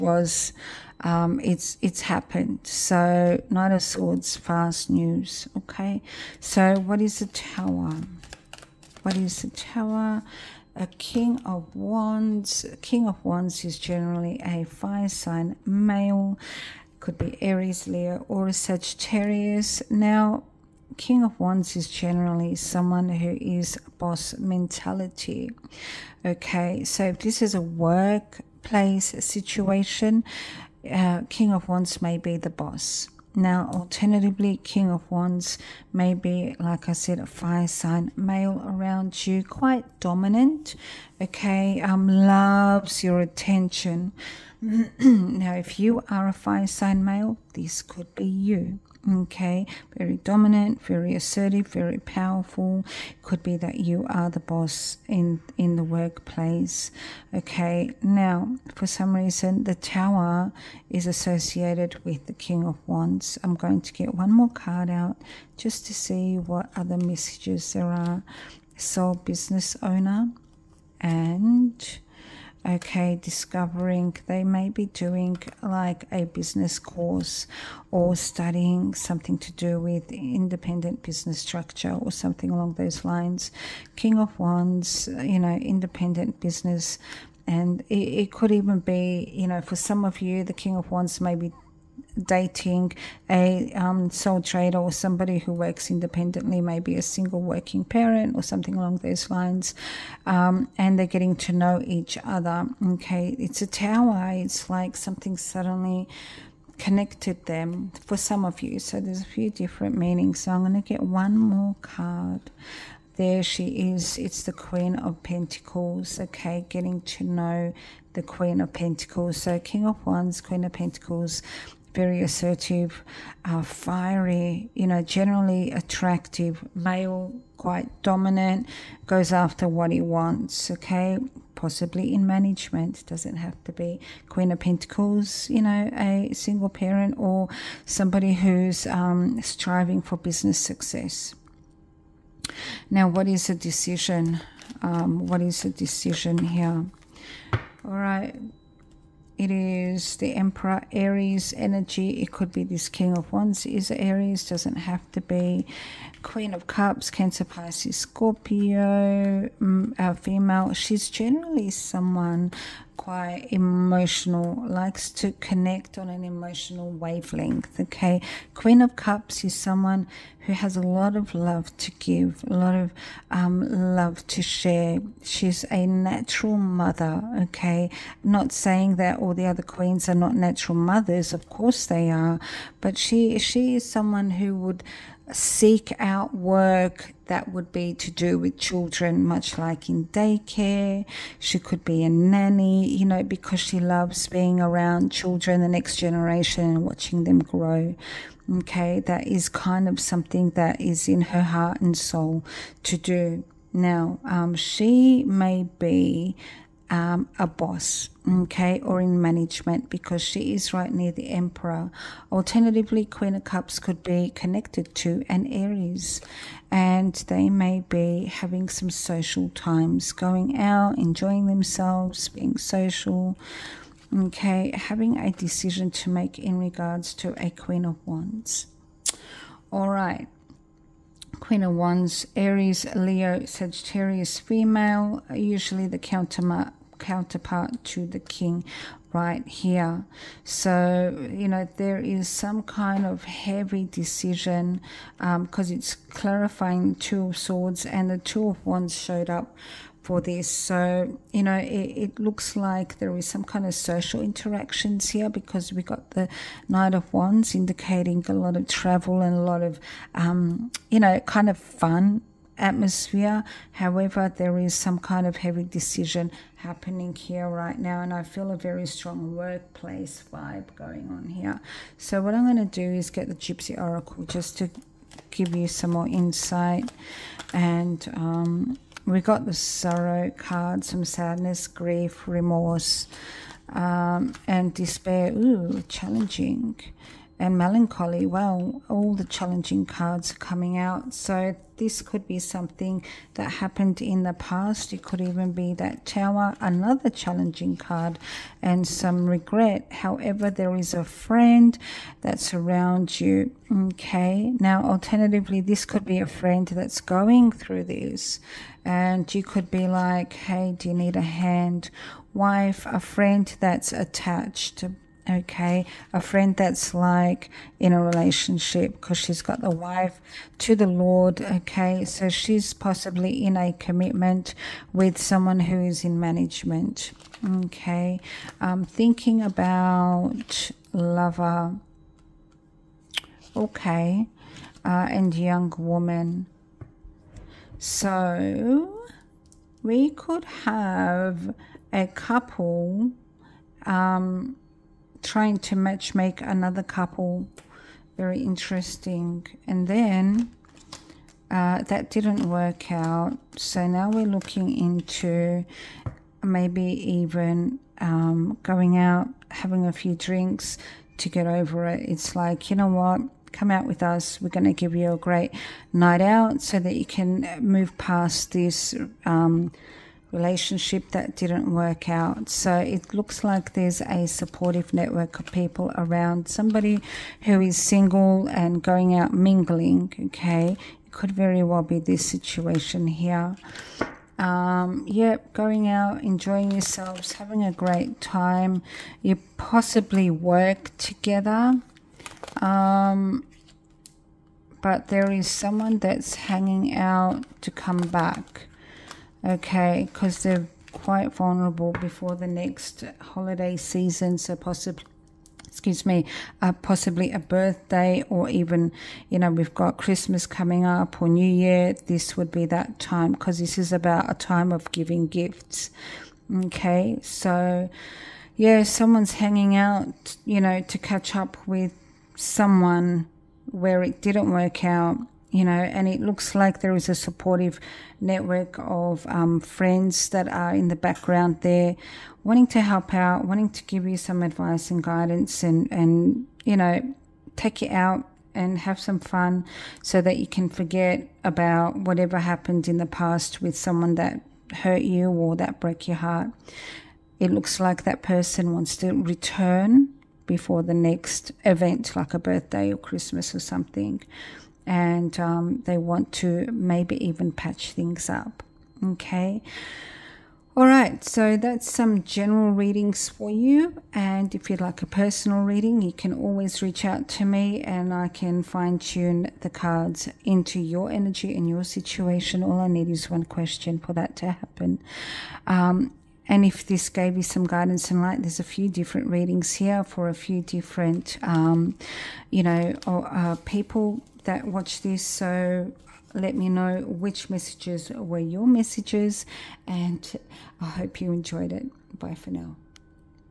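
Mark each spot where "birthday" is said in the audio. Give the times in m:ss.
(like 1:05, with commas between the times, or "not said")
6:47, 7:32.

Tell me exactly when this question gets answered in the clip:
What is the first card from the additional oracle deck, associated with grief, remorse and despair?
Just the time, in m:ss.
4:39.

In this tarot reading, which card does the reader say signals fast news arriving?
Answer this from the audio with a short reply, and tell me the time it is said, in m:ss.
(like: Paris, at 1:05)
Knight of Swords, at 0:03.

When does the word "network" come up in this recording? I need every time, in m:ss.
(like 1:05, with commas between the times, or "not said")
6:14, 7:08.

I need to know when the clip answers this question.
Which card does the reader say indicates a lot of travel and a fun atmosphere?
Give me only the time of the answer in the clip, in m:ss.
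4:16.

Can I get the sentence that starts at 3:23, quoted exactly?
Now, um, she may be um, a boss, okay, or in management because she is right near the Emperor.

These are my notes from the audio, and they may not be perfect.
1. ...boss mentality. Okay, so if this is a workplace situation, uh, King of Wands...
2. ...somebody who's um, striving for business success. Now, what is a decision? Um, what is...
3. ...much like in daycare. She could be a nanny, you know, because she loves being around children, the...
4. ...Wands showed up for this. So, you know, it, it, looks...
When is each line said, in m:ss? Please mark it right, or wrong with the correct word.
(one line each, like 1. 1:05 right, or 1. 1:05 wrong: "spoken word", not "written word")
1. 0:23 right
2. 2:17 right
3. 3:09 right
4. 4:08 right.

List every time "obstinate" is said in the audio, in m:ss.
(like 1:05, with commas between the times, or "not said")
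not said.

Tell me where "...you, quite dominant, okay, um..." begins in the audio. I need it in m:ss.
0:39.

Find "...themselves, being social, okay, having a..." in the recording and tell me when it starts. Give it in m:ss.
3:41.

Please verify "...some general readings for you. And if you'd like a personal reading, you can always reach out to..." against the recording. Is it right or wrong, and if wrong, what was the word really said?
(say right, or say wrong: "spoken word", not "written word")
right.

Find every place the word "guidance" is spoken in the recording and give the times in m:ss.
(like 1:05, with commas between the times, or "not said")
7:15, 7:57.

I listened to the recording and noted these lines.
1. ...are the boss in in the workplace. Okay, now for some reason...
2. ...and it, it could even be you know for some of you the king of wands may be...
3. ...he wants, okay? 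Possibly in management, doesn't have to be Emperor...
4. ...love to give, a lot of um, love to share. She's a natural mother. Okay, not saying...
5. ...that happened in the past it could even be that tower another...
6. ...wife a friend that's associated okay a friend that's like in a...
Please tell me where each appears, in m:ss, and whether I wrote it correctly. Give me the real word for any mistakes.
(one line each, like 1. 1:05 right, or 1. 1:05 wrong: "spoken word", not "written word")
1. 0:54 right
2. 1:27 right
3. 2:09 wrong: "Queen", not "Emperor"
4. 2:51 right
5. 4:53 right
6. 5:12 wrong: "attached", not "associated".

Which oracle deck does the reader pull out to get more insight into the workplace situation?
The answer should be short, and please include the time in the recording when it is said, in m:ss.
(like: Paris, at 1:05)
Gypsy Oracle, at 4:33.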